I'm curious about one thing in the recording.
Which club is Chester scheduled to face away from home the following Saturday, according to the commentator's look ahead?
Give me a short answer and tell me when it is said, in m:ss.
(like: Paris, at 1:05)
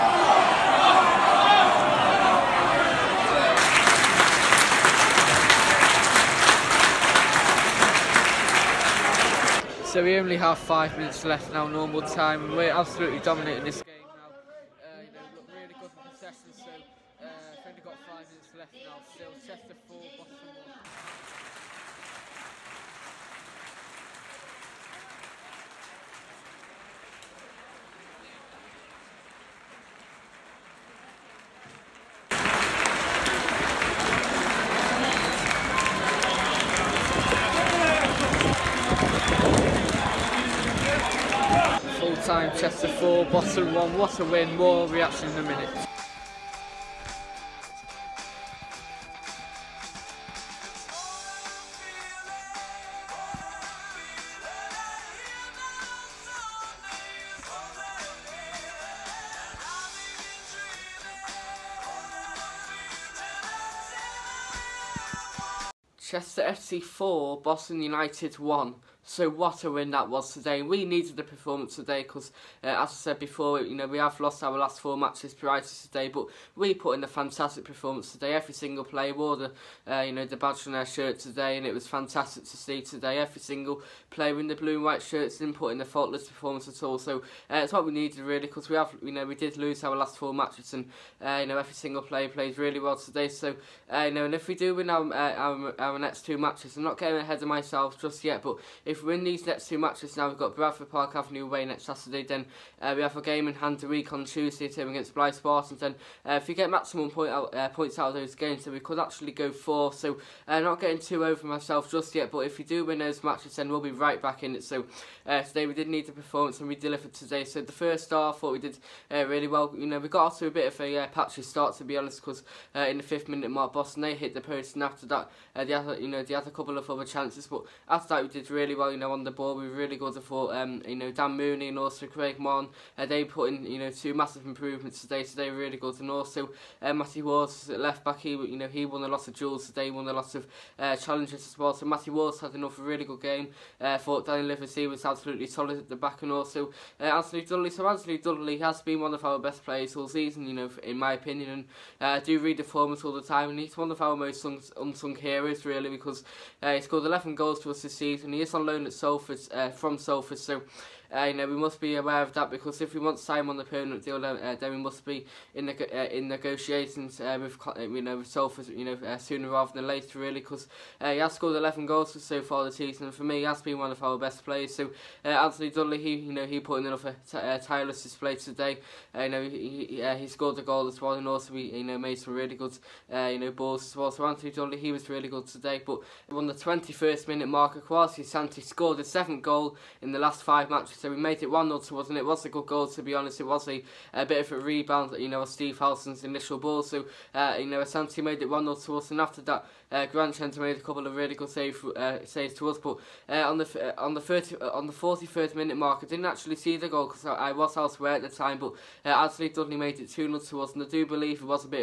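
Bradford Park Avenue, at 1:40.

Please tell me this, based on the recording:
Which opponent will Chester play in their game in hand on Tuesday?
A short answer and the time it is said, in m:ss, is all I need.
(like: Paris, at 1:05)
Blyth Spartans, at 1:45.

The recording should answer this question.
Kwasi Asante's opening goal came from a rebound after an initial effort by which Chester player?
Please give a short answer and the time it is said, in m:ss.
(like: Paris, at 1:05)
Steve Howson, at 3:15.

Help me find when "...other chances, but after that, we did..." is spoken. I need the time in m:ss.
2:06.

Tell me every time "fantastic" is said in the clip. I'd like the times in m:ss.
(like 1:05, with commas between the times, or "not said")
1:17, 1:21.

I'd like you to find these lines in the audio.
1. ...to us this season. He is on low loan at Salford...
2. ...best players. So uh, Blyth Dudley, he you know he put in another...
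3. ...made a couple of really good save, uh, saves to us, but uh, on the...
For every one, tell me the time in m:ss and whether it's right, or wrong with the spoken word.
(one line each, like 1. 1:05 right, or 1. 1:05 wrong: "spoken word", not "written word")
1. 2:37 right
2. 2:54 wrong: "Anthony", not "Blyth"
3. 3:20 right.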